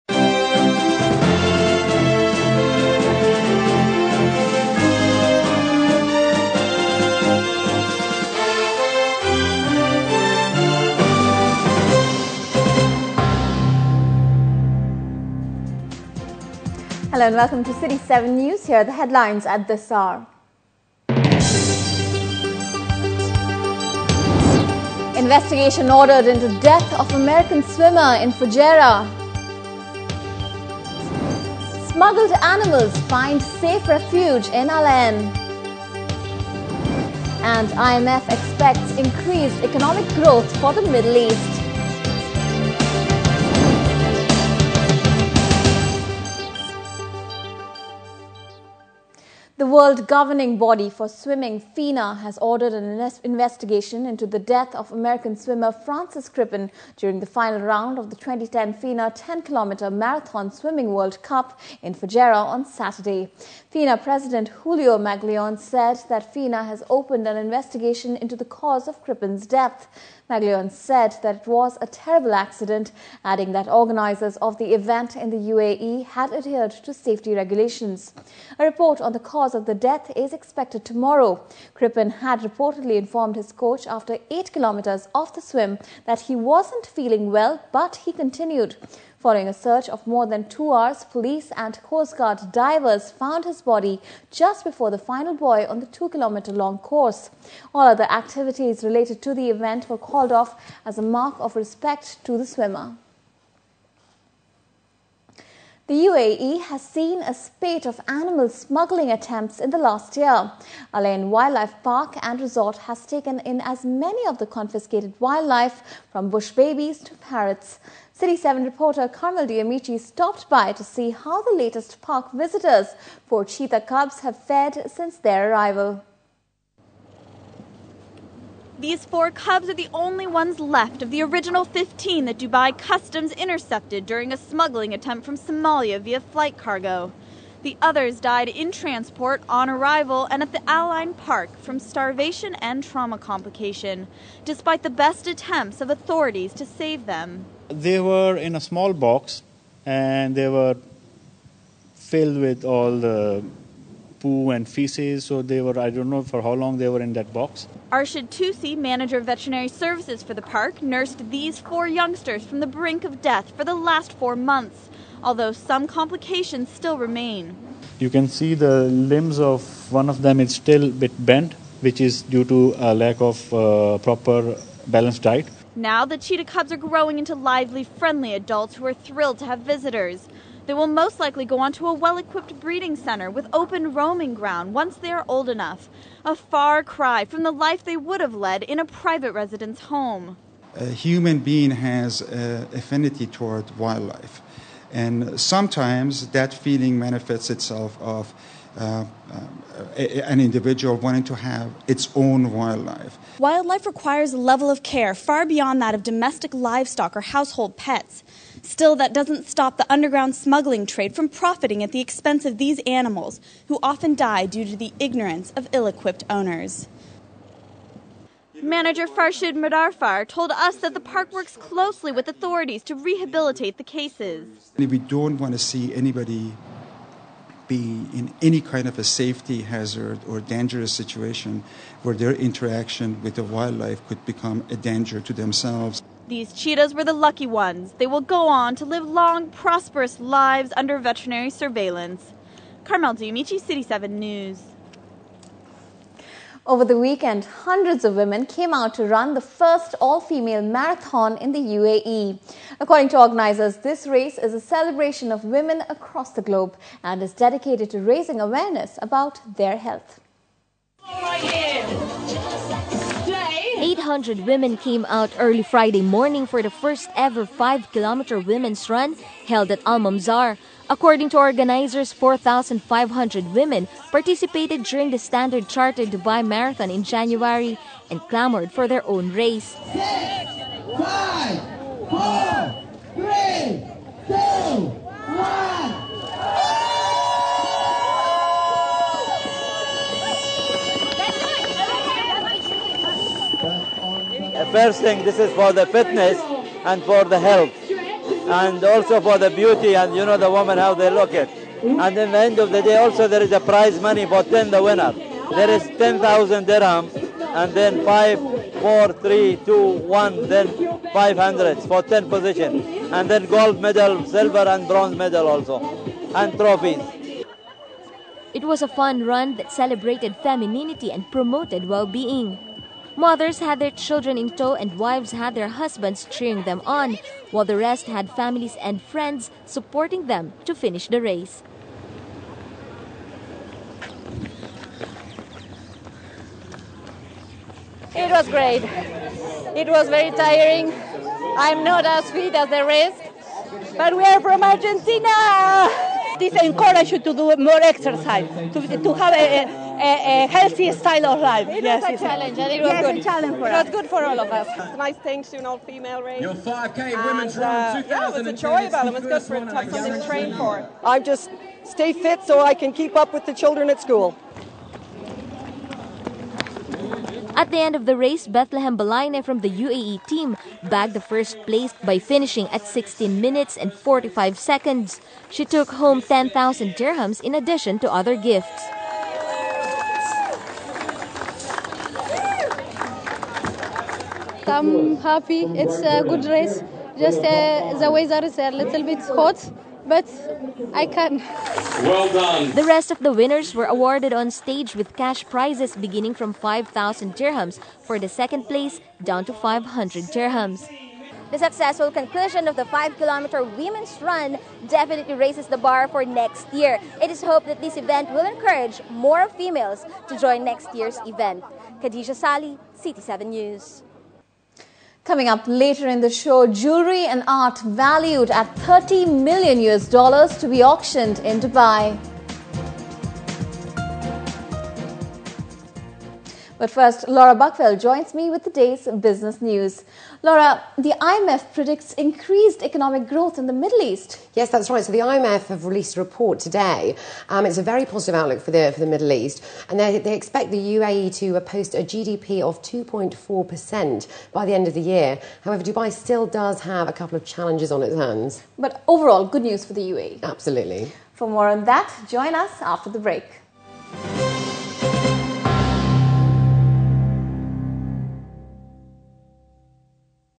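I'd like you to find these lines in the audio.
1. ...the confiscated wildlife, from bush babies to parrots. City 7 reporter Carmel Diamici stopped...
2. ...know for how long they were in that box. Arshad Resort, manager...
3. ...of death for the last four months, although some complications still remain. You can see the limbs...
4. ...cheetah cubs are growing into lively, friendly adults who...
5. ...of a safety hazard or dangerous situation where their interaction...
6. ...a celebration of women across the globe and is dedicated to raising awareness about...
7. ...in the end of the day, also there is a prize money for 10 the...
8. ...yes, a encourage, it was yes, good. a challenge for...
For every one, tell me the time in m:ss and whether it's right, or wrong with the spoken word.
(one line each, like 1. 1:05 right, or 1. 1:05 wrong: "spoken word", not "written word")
1. 1:54 right
2. 2:36 wrong: "Tusi", not "Resort"
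3. 2:43 right
4. 2:56 right
5. 3:48 right
6. 4:14 right
7. 5:02 right
8. 5:51 wrong: "challenge", not "encourage".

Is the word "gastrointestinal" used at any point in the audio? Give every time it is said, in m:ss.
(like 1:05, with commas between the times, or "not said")
not said.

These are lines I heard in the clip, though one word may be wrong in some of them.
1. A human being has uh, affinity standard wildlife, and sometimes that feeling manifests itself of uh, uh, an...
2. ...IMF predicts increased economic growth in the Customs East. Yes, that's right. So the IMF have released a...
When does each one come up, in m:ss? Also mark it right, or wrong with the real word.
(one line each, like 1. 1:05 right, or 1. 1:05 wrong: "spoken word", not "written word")
1. 3:10 wrong: "toward", not "standard"
2. 7:11 wrong: "Middle", not "Customs".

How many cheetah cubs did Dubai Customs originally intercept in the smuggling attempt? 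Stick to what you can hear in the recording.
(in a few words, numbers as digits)
15.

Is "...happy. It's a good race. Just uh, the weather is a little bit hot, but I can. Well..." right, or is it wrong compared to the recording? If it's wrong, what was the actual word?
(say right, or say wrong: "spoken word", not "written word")
right.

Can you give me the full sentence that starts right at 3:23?
Wildlife requires a level of care far beyond that of domestic livestock or household pets.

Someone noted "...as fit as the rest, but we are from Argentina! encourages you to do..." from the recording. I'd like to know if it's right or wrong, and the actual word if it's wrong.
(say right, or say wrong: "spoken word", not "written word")
right.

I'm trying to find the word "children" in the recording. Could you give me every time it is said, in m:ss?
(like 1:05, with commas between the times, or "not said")
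5:23, 6:03.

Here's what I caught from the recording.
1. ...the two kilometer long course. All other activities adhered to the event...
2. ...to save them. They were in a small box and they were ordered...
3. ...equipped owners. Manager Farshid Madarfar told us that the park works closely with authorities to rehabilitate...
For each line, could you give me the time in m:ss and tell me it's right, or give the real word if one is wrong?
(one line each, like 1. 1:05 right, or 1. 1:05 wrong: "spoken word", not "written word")
1. 1:35 wrong: "related", not "adhered"
2. 2:26 wrong: "filled", not "ordered"
3. 3:35 right.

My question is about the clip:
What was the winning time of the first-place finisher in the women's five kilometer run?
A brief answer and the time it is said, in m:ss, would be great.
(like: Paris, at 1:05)
16 minutes 45 seconds, at 6:12.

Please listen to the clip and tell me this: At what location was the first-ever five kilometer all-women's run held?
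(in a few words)
Al Mamzar.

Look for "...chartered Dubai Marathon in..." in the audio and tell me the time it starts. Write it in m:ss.
4:35.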